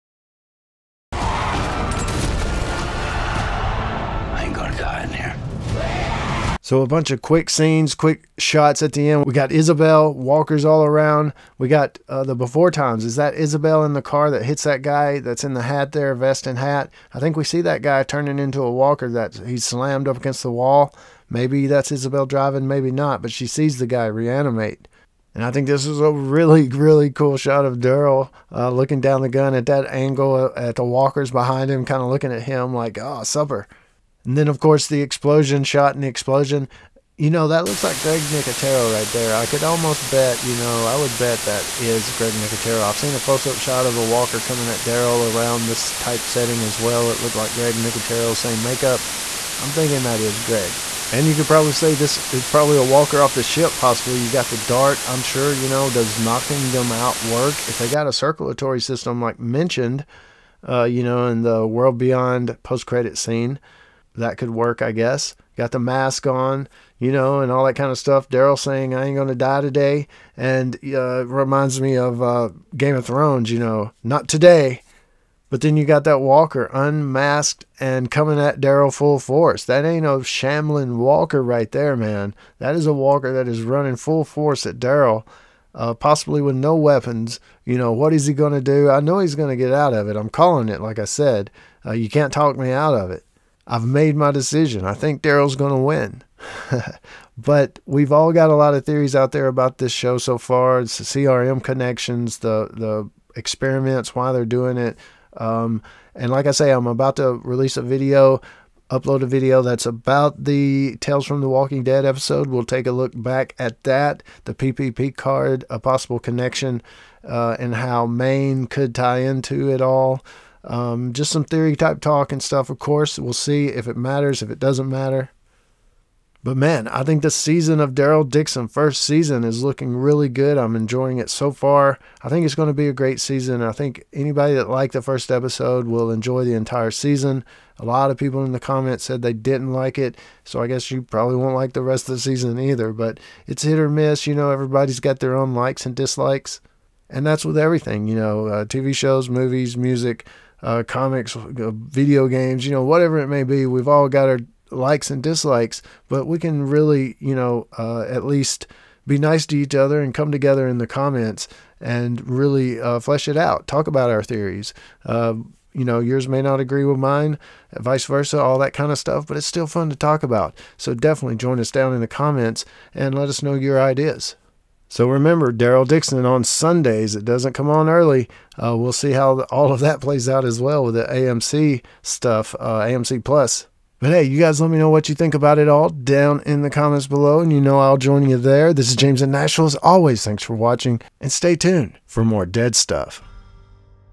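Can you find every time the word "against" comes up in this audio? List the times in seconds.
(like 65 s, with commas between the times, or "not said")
20 s.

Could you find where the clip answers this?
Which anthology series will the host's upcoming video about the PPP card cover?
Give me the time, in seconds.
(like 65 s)
111 s.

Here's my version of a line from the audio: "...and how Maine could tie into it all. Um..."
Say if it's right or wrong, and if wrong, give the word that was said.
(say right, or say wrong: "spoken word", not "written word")
right.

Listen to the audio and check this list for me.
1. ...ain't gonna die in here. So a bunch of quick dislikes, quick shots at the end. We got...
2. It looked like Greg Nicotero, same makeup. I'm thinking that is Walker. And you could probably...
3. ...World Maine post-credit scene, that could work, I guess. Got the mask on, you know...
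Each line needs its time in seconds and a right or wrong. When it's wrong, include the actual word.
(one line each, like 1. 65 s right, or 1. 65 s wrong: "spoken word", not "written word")
1. 4 s wrong: "scenes", not "dislikes"
2. 47 s wrong: "Greg", not "Walker"
3. 61 s wrong: "Beyond", not "Maine".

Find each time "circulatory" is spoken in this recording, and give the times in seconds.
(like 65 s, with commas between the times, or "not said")
58 s.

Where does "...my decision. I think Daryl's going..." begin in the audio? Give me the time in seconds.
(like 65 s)
94 s.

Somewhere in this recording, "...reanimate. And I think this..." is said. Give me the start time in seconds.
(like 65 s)
24 s.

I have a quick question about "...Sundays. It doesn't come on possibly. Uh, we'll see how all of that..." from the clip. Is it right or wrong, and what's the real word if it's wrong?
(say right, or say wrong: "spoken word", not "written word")
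wrong: "early", not "possibly".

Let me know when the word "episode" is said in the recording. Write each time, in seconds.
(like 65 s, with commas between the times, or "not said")
112 s, 135 s.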